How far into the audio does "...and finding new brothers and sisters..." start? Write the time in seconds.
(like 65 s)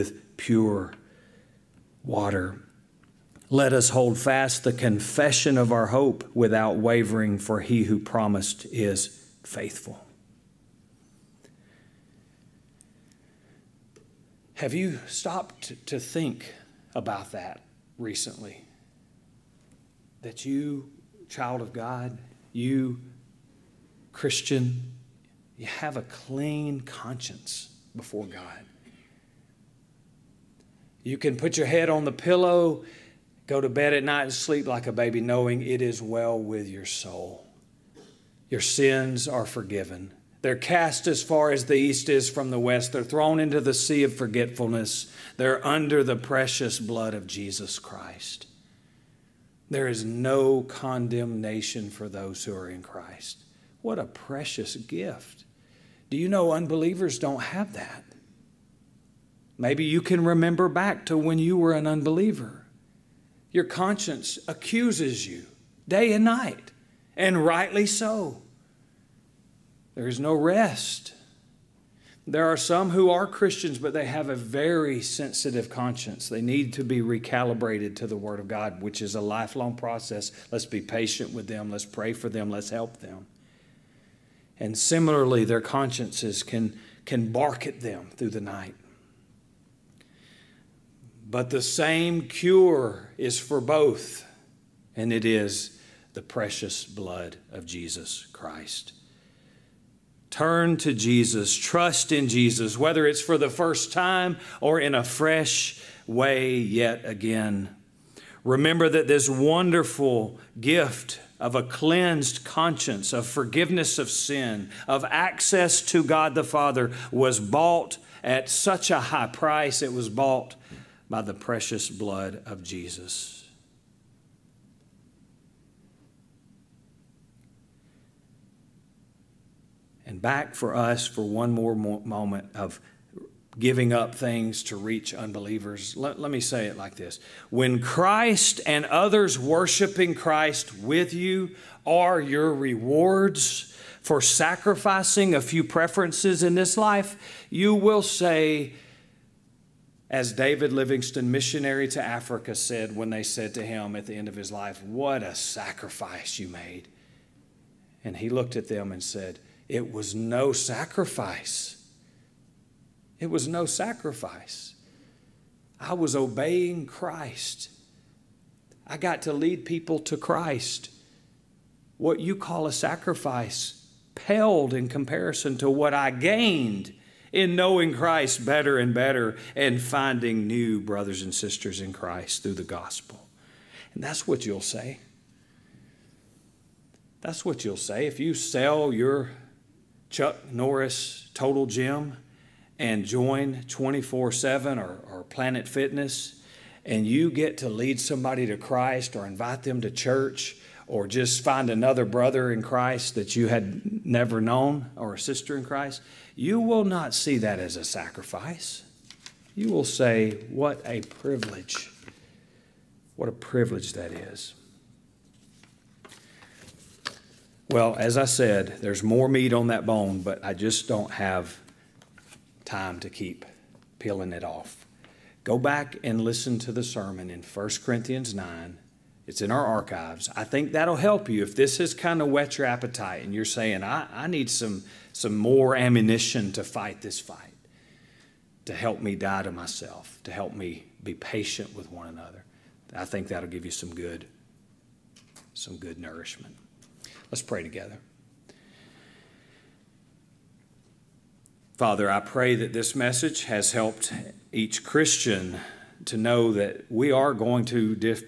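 179 s.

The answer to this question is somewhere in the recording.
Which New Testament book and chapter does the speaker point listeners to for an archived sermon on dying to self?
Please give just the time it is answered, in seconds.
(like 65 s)
227 s.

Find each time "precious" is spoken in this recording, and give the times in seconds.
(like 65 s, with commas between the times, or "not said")
46 s, 54 s, 96 s, 121 s.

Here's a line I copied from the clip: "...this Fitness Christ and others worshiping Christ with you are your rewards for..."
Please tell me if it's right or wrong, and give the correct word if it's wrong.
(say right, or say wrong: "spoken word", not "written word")
wrong: "When", not "Fitness".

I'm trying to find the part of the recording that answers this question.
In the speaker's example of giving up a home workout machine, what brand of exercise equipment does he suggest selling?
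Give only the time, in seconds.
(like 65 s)
190 s.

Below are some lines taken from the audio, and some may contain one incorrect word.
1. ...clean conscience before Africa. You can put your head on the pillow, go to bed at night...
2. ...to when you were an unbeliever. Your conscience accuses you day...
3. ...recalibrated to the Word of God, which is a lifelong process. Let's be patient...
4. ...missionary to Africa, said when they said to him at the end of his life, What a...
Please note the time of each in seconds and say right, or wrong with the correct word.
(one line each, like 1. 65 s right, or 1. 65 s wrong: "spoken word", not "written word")
1. 26 s wrong: "God", not "Africa"
2. 61 s right
3. 76 s right
4. 151 s right.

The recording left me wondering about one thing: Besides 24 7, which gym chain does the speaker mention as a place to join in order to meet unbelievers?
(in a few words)
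Planet Fitness.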